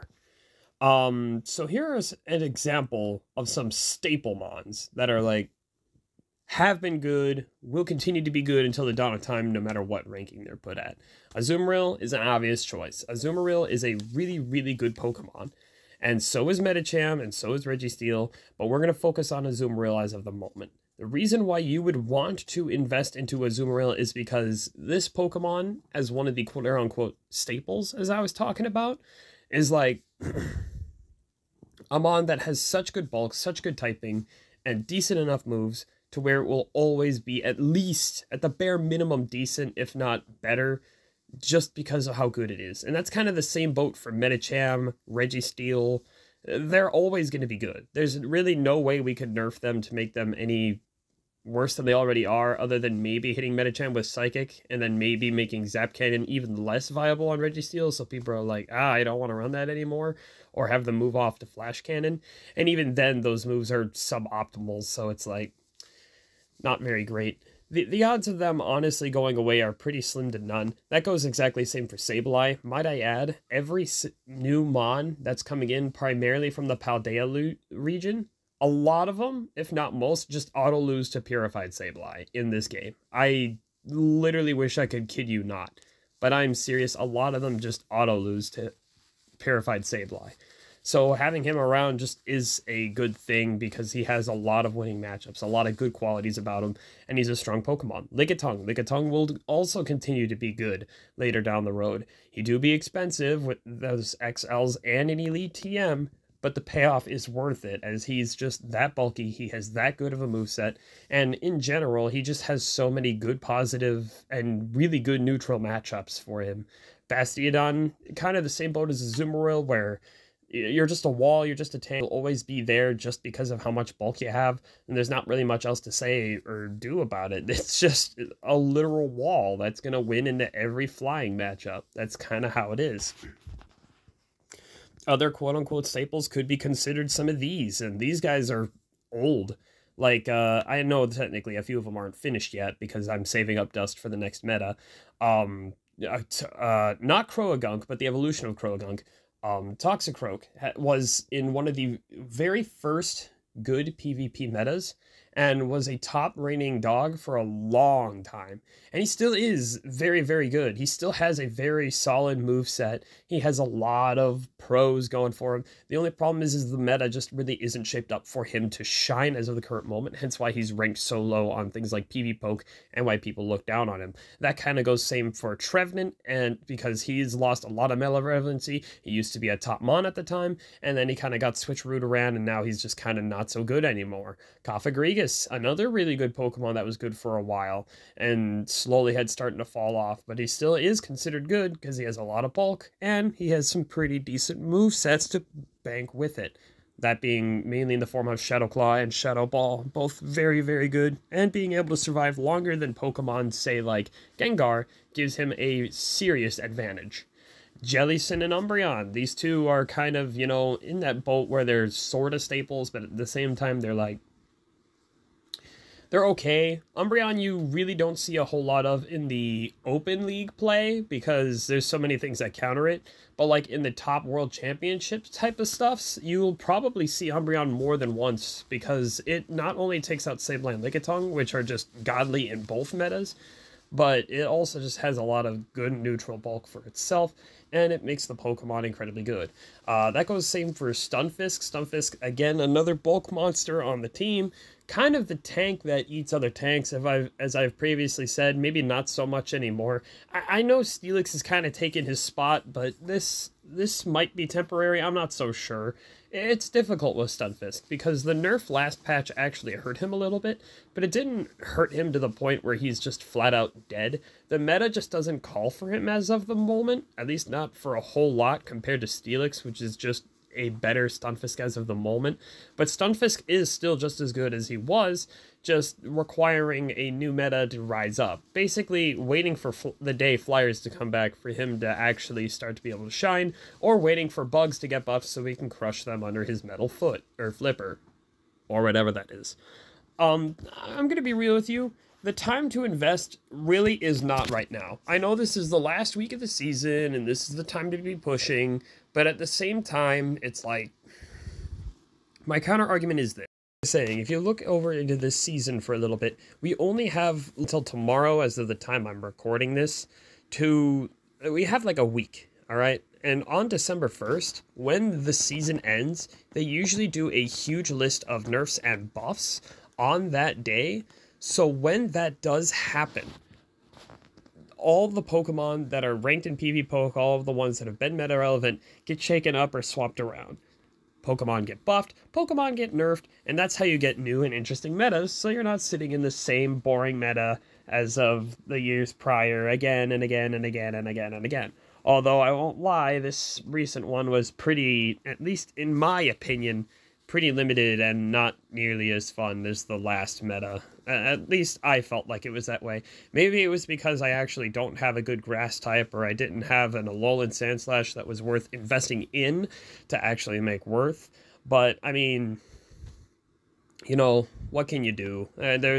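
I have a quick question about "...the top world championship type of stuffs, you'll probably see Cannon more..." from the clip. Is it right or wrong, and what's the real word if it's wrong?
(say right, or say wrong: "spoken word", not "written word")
wrong: "Umbreon", not "Cannon".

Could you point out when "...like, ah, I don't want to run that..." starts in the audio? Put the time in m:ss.
0:58.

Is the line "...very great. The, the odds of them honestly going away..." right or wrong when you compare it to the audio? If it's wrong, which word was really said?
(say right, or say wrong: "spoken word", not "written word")
right.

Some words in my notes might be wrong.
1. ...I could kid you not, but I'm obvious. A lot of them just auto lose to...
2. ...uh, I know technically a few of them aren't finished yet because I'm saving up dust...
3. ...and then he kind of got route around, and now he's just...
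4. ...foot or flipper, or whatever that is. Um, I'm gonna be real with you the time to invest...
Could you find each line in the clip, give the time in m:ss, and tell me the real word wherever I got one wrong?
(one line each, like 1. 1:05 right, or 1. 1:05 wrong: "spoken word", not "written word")
1. 1:24 wrong: "serious", not "obvious"
2. 2:20 right
3. 3:00 right
4. 4:46 right.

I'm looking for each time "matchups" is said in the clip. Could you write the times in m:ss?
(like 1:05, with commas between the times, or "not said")
1:35, 1:55, 2:11.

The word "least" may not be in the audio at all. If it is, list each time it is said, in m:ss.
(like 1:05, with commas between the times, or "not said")
0:37, 4:27, 5:45, 5:51.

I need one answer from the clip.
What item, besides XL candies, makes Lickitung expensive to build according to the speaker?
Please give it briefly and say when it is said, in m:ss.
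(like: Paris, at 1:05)
Elite TM, at 1:45.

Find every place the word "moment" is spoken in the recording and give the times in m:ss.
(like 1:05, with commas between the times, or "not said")
0:20, 2:49, 4:26, 4:31.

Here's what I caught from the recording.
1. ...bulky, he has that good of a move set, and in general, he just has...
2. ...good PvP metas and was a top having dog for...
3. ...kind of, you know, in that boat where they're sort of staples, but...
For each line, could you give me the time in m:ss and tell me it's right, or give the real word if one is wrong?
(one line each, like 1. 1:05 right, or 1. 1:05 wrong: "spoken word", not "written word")
1. 1:48 right
2. 2:33 wrong: "reigning", not "having"
3. 3:29 right.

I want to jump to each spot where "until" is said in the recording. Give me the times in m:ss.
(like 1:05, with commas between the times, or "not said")
0:08, 5:07.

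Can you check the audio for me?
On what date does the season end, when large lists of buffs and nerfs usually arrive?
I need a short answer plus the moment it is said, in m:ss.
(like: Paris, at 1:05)
December 1st, at 5:13.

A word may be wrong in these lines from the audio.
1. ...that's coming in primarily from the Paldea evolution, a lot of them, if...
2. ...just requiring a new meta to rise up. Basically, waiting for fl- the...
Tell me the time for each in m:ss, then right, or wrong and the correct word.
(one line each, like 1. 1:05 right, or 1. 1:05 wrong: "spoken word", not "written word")
1. 1:15 wrong: "region", not "evolution"
2. 4:35 right.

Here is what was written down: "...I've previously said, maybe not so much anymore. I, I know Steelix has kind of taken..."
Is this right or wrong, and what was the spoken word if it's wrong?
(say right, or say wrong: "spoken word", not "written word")
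right.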